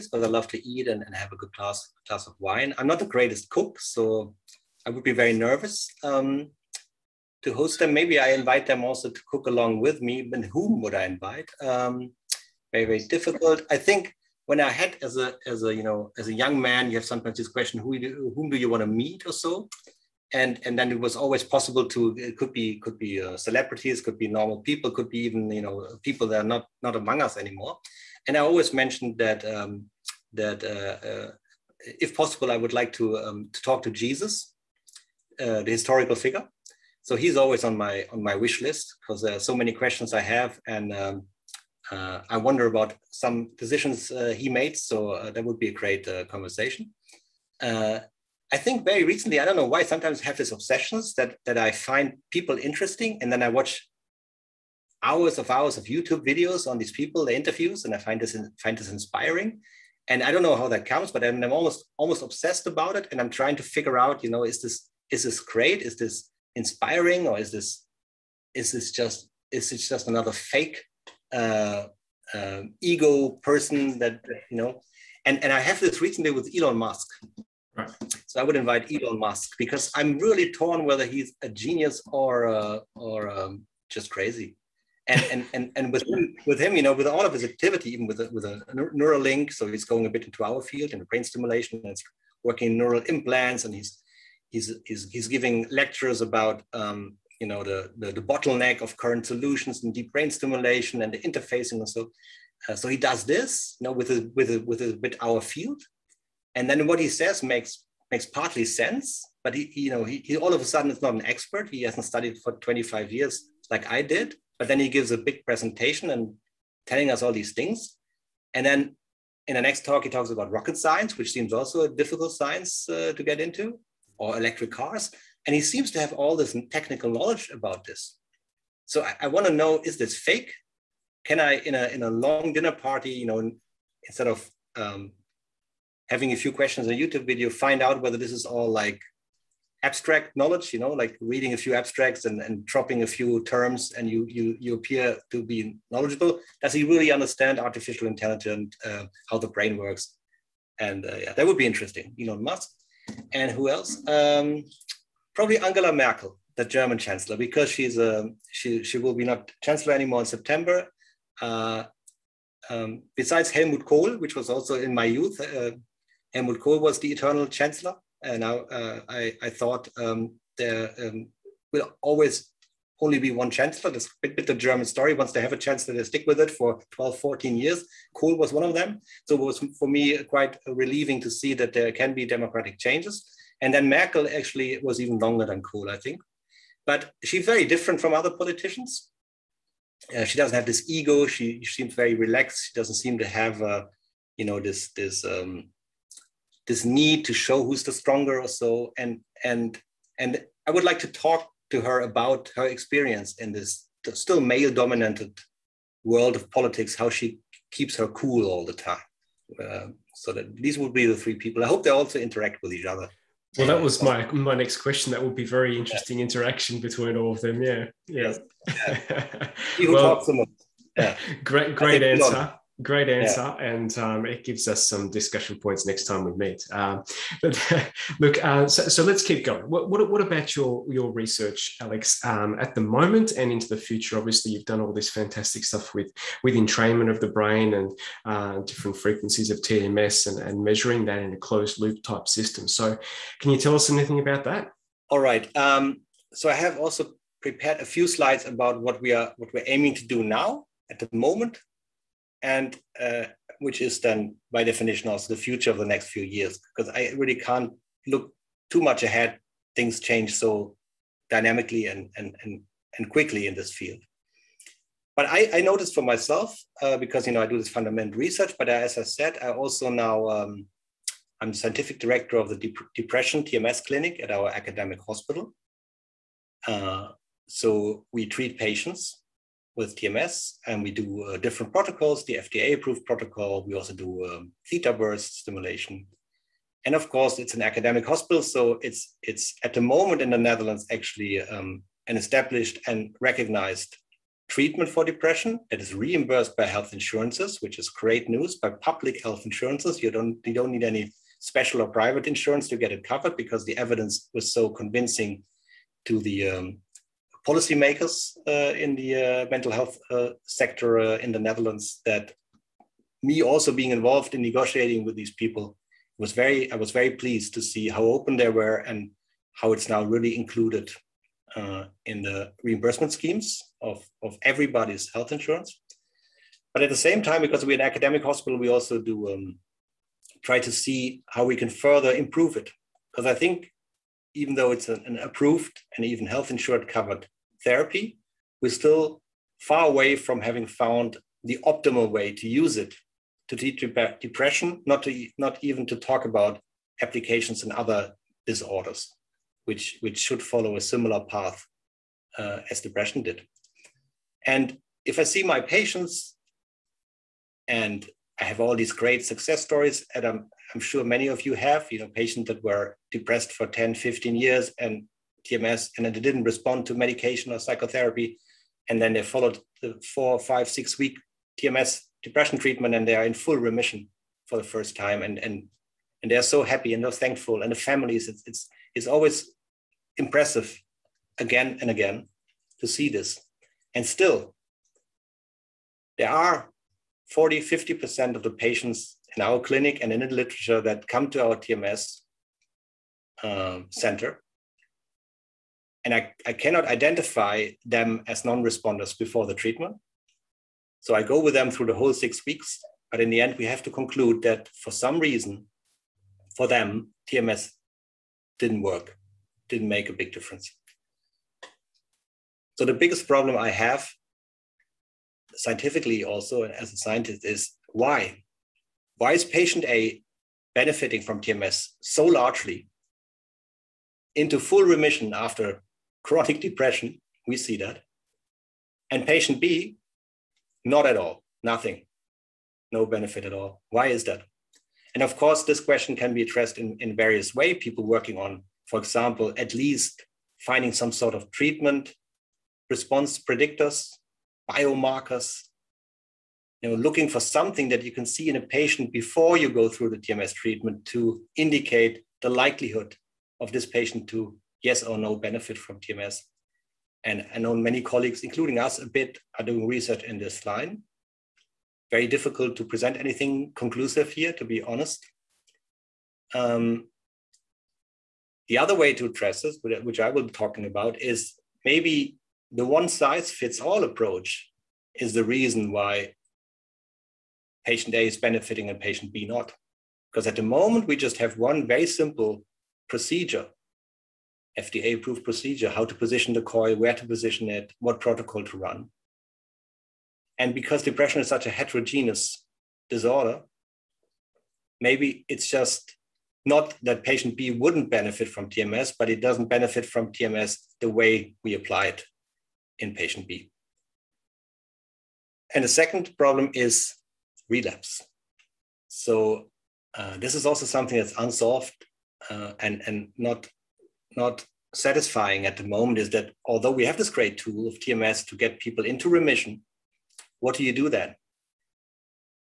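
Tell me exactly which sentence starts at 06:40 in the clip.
So I go with them through the whole six weeks.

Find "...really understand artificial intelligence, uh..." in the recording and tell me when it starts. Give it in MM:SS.
02:26.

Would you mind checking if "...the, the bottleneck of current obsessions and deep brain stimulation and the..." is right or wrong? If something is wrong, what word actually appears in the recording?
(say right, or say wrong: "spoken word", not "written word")
wrong: "solutions", not "obsessions".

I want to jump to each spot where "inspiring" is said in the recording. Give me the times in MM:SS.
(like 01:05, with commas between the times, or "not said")
00:58, 01:06.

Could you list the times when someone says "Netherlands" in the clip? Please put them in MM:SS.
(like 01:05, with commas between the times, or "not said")
04:50, 05:11.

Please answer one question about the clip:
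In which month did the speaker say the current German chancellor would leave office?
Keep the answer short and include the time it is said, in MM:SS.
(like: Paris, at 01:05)
September, at 02:40.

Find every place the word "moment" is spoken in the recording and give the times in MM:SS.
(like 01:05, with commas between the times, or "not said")
03:52, 04:11, 04:49, 08:00, 08:35.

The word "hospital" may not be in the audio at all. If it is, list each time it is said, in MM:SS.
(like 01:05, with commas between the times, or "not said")
04:35, 04:48, 05:28.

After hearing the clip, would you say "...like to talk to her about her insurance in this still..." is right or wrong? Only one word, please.
wrong.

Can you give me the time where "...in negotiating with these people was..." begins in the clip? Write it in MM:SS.
05:14.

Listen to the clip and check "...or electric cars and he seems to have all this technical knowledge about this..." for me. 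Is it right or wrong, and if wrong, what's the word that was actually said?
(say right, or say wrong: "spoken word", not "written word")
right.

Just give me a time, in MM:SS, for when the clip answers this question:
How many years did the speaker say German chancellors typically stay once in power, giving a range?
02:56.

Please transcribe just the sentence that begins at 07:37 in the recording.
And I know many colleagues, including us a bit, are doing research in this line.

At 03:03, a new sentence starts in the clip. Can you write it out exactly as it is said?
And then Merkel actually was even longer than Kohl, I think.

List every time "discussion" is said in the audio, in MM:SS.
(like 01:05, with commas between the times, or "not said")
03:45.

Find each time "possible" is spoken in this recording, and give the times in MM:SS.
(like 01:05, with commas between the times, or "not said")
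00:21, 00:32.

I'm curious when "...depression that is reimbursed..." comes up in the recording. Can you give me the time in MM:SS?
04:55.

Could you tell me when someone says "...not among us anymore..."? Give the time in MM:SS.
00:26.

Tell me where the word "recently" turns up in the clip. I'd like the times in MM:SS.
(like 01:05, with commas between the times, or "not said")
00:49, 01:16.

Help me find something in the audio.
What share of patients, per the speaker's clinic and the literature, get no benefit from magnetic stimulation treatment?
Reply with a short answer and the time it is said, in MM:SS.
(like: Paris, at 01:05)
40-50%, at 06:27.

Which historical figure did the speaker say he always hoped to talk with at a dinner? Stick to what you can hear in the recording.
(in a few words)
Jesus.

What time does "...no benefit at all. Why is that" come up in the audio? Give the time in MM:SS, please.
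07:12.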